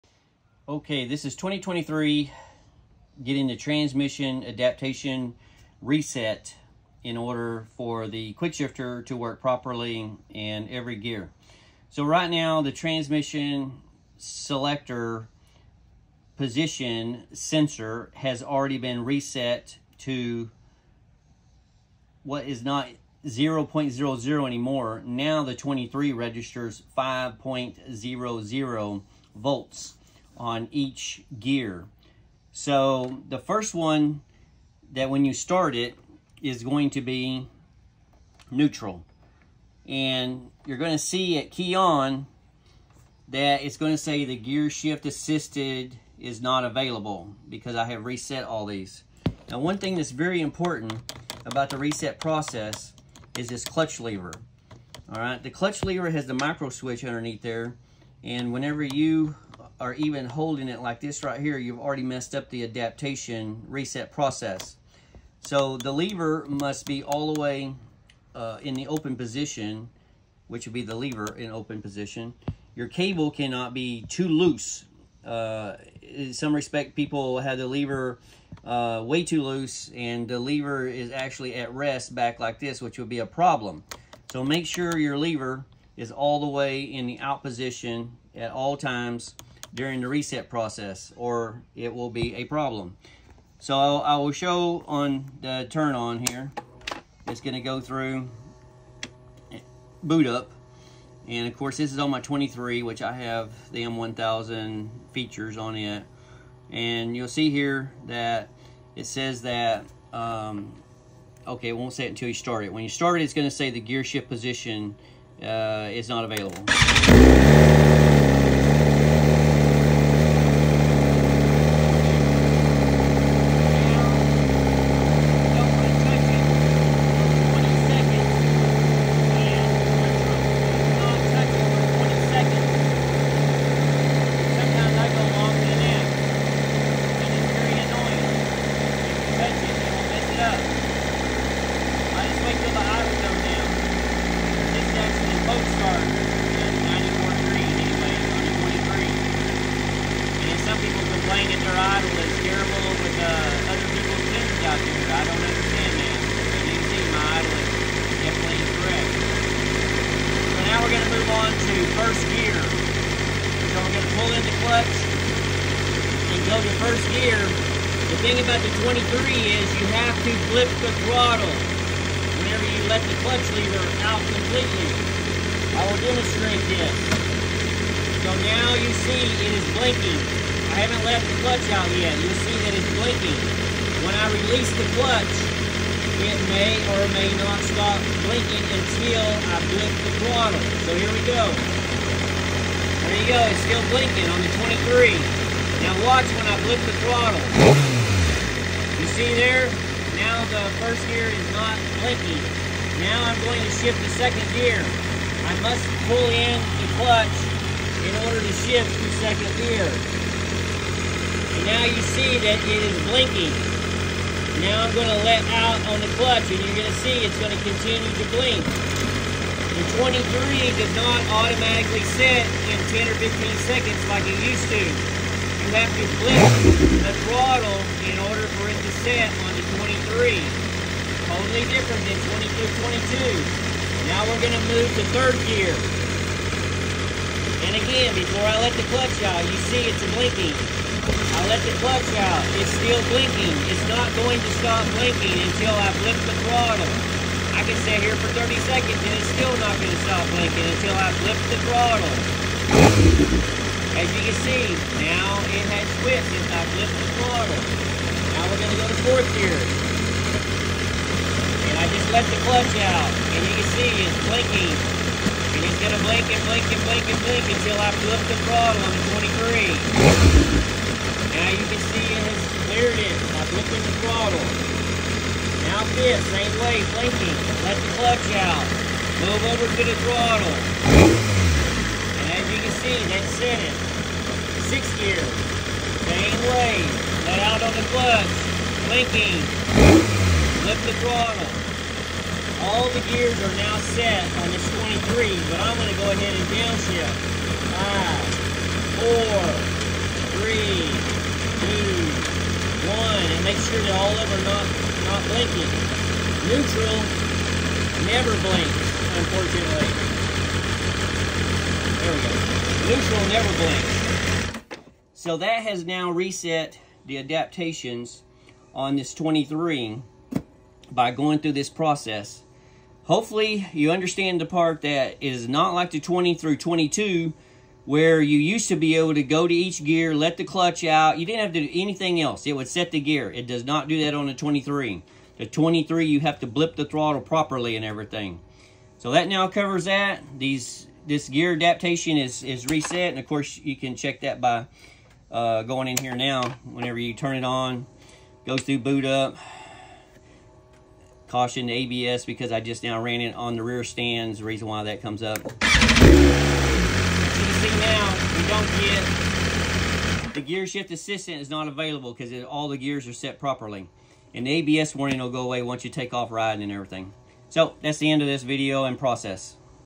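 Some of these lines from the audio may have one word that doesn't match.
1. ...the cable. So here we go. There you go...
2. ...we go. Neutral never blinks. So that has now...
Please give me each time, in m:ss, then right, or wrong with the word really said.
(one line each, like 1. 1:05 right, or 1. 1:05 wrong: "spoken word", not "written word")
1. 3:09 wrong: "throttle", not "cable"
2. 5:12 right.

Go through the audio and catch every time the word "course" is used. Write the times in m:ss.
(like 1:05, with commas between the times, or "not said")
1:41, 5:43.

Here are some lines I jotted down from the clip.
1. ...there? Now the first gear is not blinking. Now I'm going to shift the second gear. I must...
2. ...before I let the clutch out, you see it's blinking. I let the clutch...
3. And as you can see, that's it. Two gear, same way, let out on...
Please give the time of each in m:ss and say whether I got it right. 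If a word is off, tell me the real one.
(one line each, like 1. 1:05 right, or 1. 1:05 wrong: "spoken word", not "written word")
1. 3:19 right
2. 3:58 right
3. 4:40 wrong: "Six", not "Two".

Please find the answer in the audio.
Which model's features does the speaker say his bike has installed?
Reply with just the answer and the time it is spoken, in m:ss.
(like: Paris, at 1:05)
M1000, at 1:43.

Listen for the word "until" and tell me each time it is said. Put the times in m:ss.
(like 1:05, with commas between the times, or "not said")
1:52, 3:08, 4:05, 4:10, 4:27.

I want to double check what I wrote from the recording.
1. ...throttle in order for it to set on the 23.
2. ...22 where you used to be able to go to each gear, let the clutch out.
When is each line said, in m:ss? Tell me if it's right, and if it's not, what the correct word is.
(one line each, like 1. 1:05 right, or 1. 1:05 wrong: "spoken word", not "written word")
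1. 3:47 right
2. 5:26 right.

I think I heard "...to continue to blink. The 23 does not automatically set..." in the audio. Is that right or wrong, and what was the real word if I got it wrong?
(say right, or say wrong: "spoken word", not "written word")
right.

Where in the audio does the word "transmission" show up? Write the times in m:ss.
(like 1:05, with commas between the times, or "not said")
0:03, 0:12.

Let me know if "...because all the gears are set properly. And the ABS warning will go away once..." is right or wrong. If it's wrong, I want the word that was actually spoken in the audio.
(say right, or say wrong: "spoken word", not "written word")
right.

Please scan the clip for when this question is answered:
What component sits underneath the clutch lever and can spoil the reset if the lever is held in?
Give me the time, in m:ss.
0:56.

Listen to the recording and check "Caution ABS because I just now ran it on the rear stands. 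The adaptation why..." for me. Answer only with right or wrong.
wrong.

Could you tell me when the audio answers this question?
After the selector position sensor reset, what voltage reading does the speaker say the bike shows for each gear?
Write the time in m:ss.
0:26.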